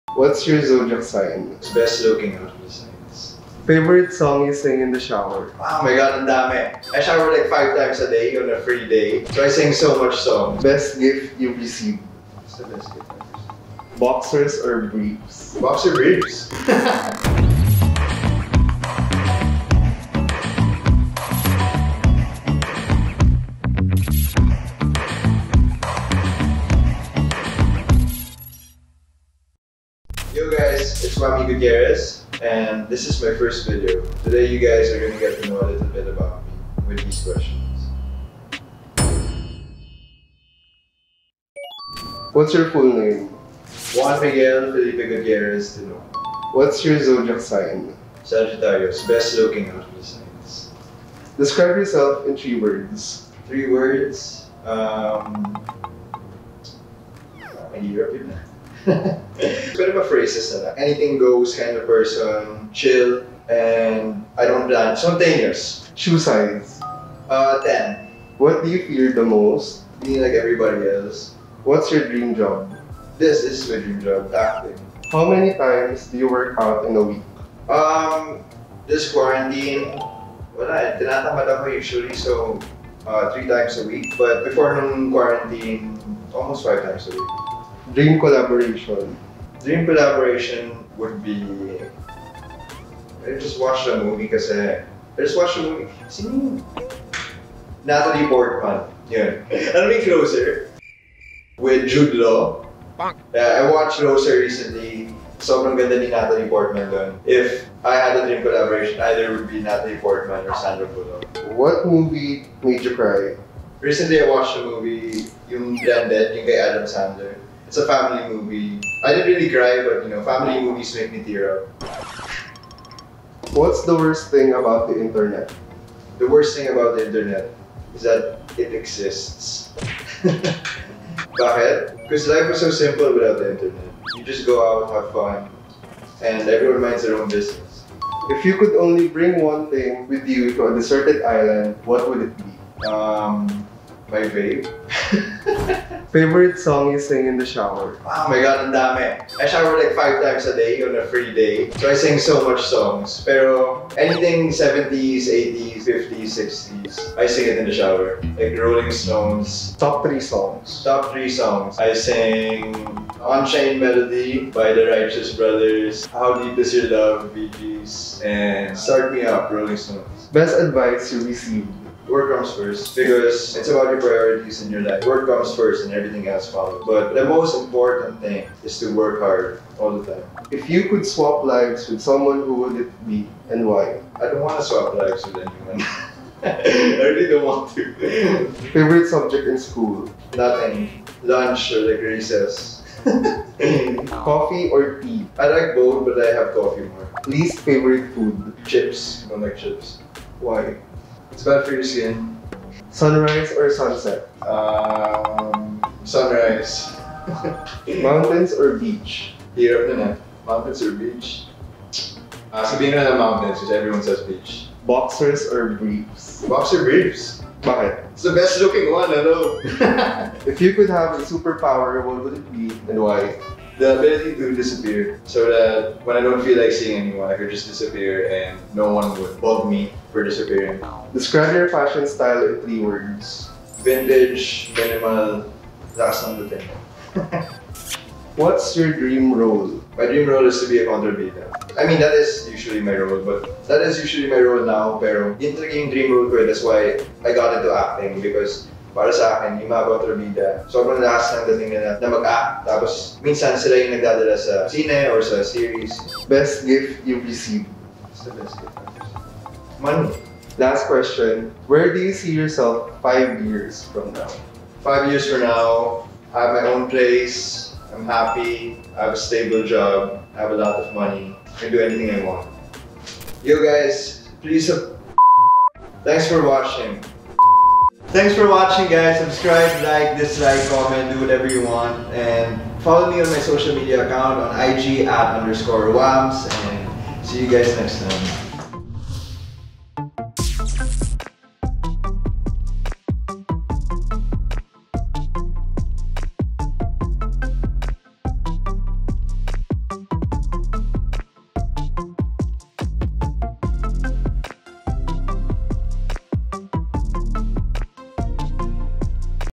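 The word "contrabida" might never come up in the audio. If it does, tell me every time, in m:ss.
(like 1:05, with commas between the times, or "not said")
4:00.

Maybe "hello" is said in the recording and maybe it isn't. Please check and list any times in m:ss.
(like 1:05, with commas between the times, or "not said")
3:39.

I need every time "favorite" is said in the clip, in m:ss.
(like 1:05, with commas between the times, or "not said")
0:03, 2:26, 3:08, 3:17.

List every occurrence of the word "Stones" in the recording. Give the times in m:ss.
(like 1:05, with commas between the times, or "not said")
2:38, 2:49.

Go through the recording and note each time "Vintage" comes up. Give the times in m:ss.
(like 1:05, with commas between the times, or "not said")
3:53.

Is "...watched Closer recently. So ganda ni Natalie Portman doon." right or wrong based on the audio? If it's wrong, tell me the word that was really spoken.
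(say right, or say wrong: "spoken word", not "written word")
right.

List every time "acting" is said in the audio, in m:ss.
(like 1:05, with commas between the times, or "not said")
1:14, 4:07.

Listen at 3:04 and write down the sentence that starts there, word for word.
I don't want to swap lives with anyone.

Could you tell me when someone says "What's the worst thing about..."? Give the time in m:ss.
2:03.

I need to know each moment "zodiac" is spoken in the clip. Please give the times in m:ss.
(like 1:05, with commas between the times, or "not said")
0:00, 0:47.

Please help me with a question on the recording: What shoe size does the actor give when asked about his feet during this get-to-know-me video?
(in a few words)
10.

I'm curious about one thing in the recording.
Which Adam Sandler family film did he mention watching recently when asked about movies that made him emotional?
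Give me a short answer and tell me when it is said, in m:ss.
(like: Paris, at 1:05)
Blended, at 1:55.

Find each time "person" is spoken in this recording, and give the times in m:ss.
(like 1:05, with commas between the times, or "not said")
1:01.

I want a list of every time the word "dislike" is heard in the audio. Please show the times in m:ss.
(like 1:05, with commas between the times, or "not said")
4:40.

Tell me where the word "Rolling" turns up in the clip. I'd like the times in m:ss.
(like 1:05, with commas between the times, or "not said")
2:38, 2:49.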